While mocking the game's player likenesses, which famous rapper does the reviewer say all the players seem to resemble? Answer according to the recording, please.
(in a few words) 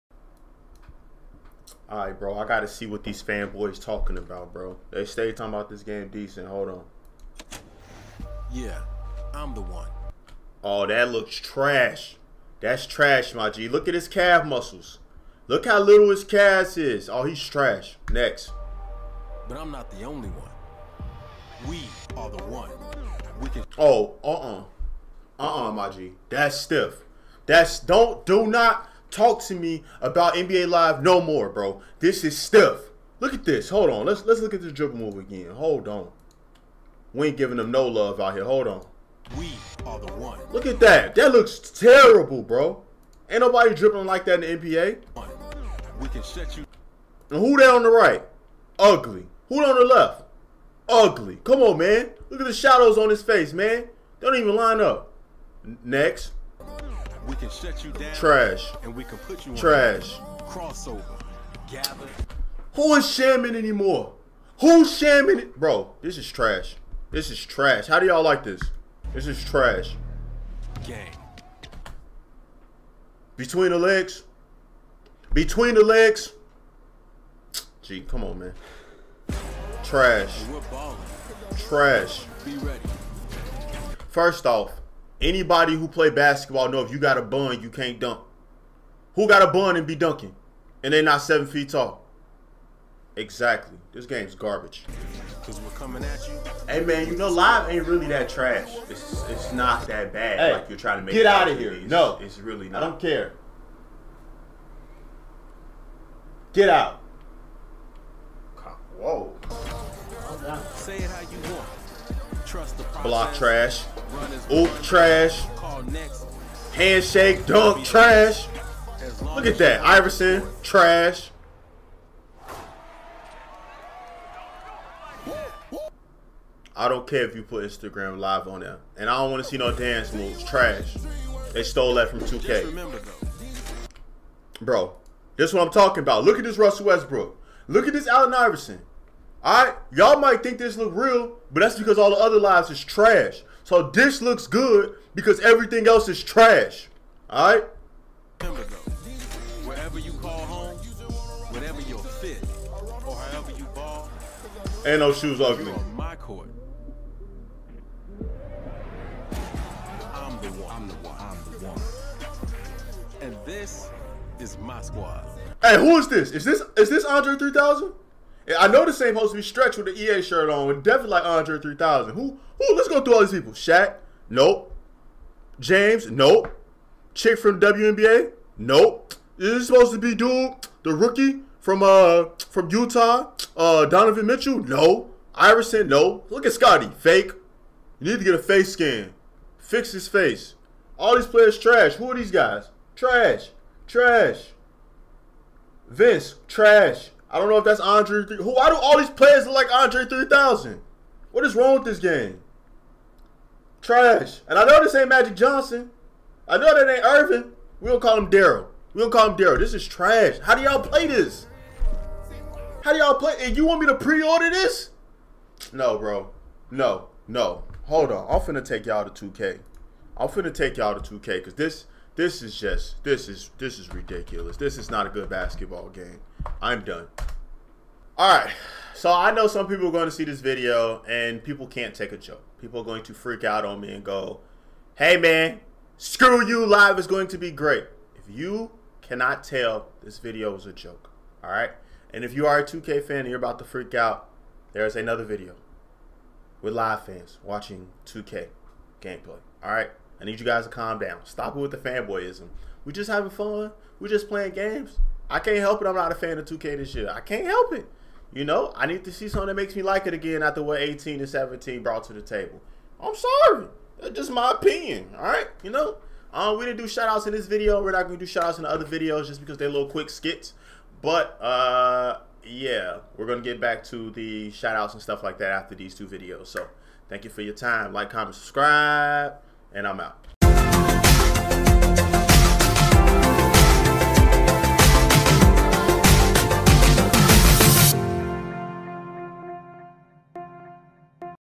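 Andre 3000.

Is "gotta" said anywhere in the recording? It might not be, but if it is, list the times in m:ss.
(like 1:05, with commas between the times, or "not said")
0:02.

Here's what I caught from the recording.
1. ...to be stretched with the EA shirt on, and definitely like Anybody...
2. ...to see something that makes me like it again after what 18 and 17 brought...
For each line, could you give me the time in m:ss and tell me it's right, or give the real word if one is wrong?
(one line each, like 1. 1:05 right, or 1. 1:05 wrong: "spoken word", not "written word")
1. 2:49 wrong: "Andre", not "Anybody"
2. 4:19 right.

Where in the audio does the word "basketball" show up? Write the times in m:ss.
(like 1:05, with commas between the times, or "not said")
1:26, 3:45.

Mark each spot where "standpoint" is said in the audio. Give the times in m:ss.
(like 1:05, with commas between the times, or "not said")
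not said.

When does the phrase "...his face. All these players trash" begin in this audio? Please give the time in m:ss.
3:09.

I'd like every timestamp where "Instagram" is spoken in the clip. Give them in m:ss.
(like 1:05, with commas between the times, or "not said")
2:07.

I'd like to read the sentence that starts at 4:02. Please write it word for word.
And if you are a 2K fan and you're about to freak out, there's another video with live fans watching 2K gameplay.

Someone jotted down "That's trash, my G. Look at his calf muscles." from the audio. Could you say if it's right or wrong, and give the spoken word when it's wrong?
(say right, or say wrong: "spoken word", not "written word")
right.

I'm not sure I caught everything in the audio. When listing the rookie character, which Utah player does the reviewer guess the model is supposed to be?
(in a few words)
Donovan Mitchell.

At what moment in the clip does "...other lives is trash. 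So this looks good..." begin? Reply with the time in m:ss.
2:22.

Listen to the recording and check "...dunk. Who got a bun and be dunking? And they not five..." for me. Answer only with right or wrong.
wrong.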